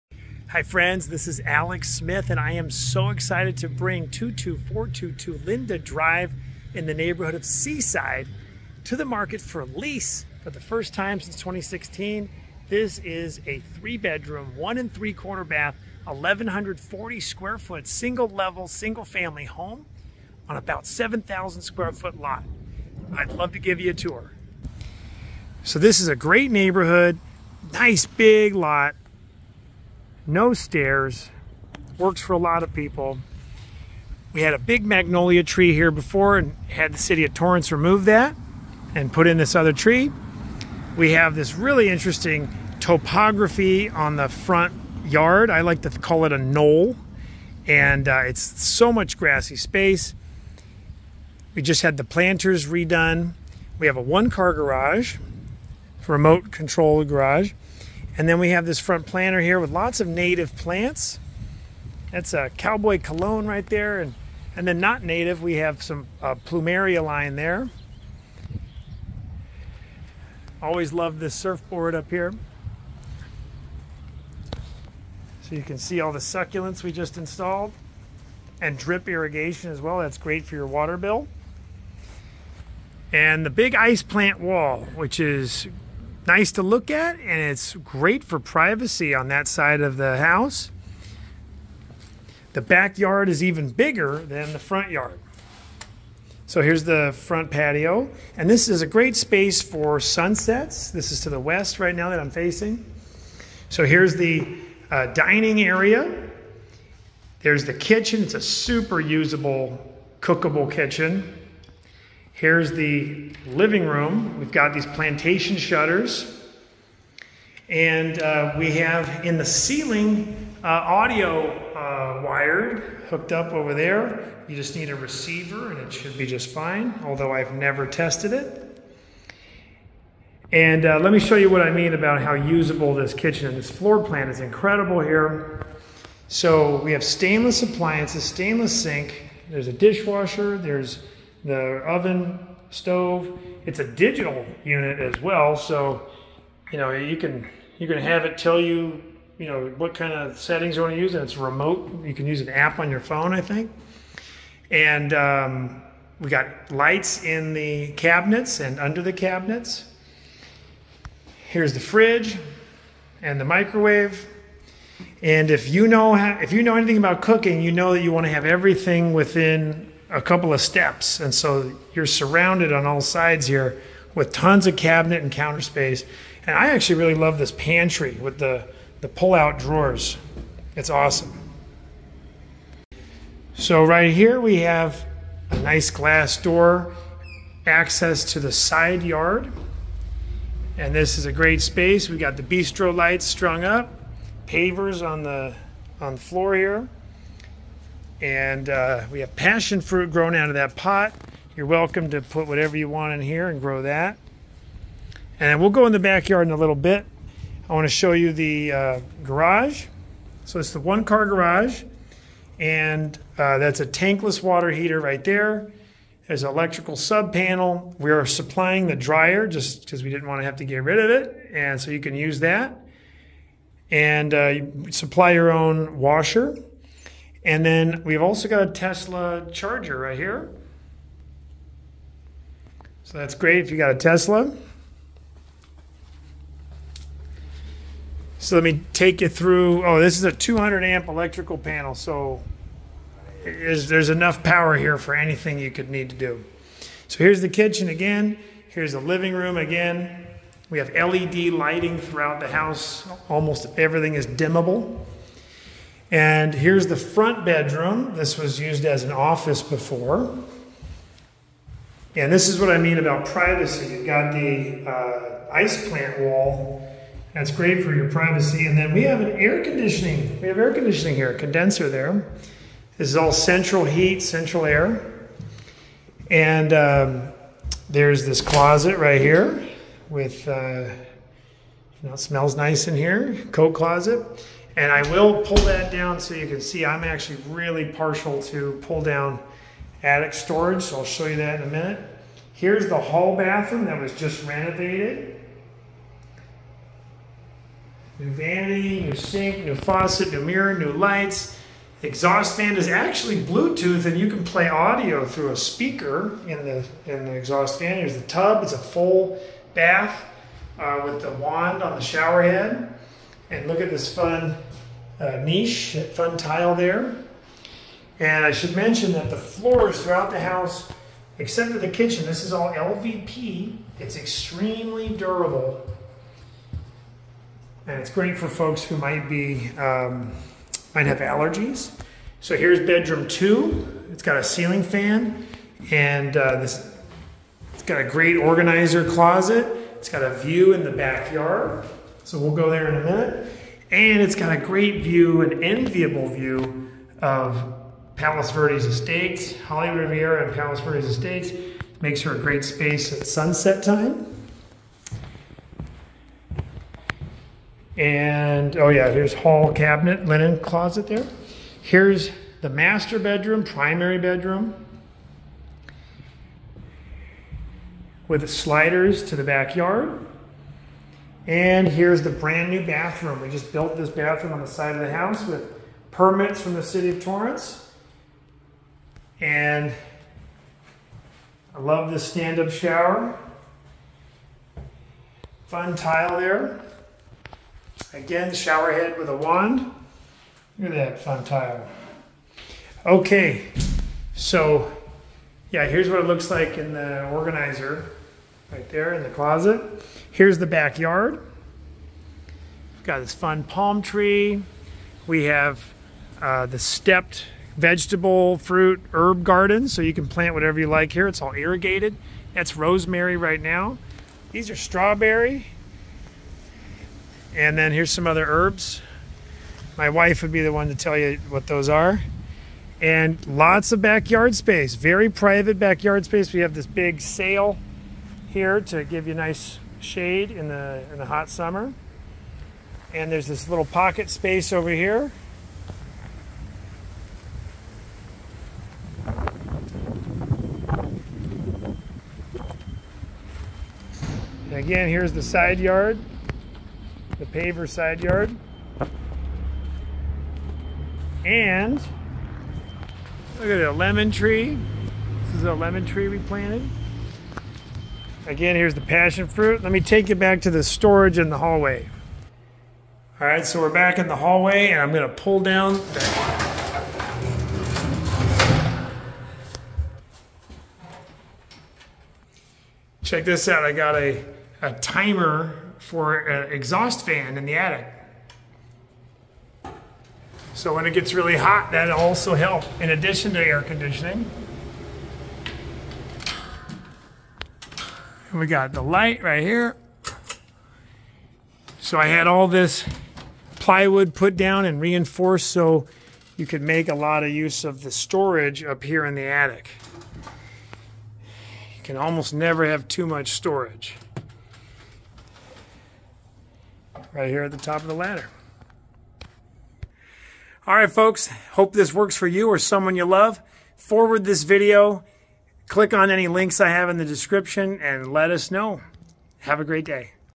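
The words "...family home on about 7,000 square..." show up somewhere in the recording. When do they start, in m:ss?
0:19.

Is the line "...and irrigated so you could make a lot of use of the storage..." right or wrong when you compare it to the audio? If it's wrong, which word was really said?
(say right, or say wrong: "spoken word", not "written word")
wrong: "reinforced", not "irrigated".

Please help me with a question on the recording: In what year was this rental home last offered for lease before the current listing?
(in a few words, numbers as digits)
2016.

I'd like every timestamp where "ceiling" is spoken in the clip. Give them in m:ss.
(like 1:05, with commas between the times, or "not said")
1:59, 5:34.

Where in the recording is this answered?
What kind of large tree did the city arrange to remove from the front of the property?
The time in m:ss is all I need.
0:34.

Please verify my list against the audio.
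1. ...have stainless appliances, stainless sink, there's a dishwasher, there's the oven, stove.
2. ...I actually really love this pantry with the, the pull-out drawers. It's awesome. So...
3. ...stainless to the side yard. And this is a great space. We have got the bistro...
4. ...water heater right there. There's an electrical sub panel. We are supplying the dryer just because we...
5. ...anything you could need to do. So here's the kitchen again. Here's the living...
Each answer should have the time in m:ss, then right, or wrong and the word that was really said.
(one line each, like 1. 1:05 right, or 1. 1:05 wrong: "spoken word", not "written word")
1. 2:16 right
2. 2:56 right
3. 3:07 wrong: "access", not "stainless"
4. 3:34 right
5. 4:05 right.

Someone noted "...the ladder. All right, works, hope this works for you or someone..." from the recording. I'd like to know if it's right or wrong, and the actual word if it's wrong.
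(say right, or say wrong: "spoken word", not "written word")
wrong: "folks", not "works".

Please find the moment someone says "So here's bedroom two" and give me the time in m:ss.
5:32.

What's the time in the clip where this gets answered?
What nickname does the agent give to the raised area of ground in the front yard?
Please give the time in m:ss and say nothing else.
0:46.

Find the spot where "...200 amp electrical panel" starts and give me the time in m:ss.
4:00.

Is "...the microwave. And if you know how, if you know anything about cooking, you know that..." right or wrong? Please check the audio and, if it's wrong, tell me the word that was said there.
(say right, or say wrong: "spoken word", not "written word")
right.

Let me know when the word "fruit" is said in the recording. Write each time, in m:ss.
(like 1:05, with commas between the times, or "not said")
3:19, 6:48, 7:39.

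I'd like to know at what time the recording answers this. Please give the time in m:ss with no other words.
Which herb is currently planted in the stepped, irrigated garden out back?
6:52.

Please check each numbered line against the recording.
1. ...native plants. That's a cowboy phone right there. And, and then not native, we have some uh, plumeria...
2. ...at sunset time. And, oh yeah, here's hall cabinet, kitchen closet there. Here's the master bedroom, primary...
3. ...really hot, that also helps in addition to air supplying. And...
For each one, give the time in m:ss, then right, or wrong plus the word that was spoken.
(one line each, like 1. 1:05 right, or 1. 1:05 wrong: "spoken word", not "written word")
1. 1:00 wrong: "cologne", not "phone"
2. 5:53 wrong: "linen", not "kitchen"
3. 8:01 wrong: "conditioning", not "supplying".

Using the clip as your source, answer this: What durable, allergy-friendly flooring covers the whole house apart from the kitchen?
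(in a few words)
LVP.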